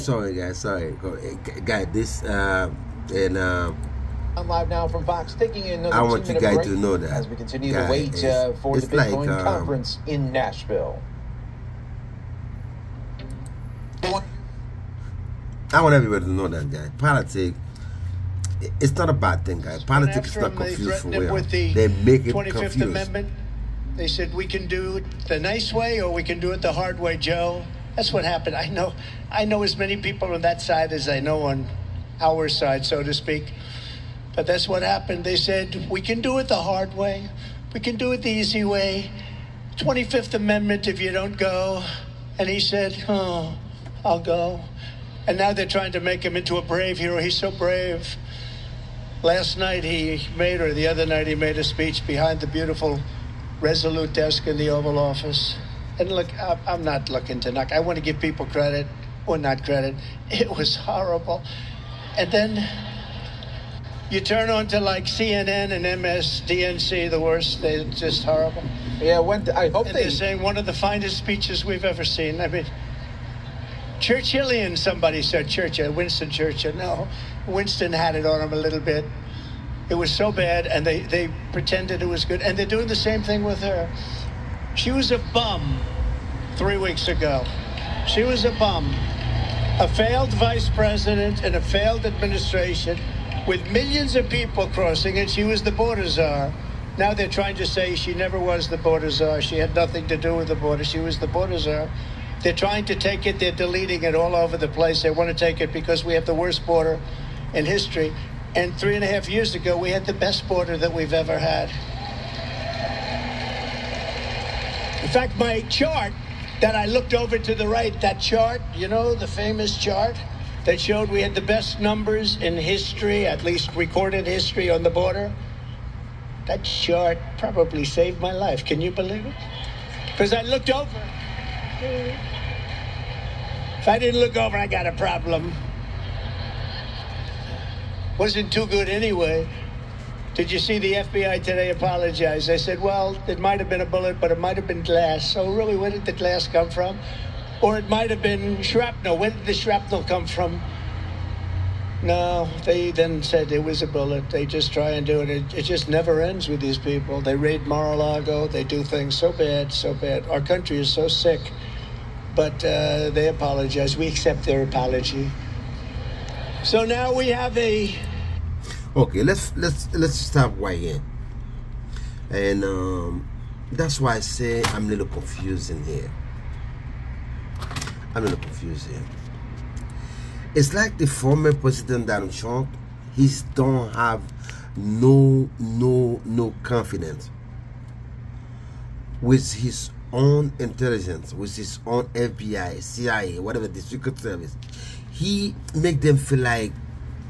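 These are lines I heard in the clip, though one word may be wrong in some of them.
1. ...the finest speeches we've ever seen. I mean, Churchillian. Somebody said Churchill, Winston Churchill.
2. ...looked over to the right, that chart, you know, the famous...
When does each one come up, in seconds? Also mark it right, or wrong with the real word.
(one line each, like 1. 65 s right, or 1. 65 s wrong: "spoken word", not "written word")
1. 70 s right
2. 116 s right.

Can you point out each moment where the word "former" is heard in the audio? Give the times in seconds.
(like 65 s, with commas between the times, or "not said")
181 s.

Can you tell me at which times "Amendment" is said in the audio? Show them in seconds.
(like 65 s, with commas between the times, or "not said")
22 s, 40 s.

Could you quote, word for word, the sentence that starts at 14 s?
I want everybody to know that, guy.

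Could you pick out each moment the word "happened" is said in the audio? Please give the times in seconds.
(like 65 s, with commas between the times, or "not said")
28 s, 34 s.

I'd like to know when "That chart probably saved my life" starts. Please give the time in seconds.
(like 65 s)
126 s.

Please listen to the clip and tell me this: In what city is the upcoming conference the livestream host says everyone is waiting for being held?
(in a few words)
Nashville.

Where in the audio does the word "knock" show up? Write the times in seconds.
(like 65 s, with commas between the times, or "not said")
57 s.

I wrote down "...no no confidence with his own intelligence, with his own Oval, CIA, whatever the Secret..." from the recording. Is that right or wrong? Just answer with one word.
wrong.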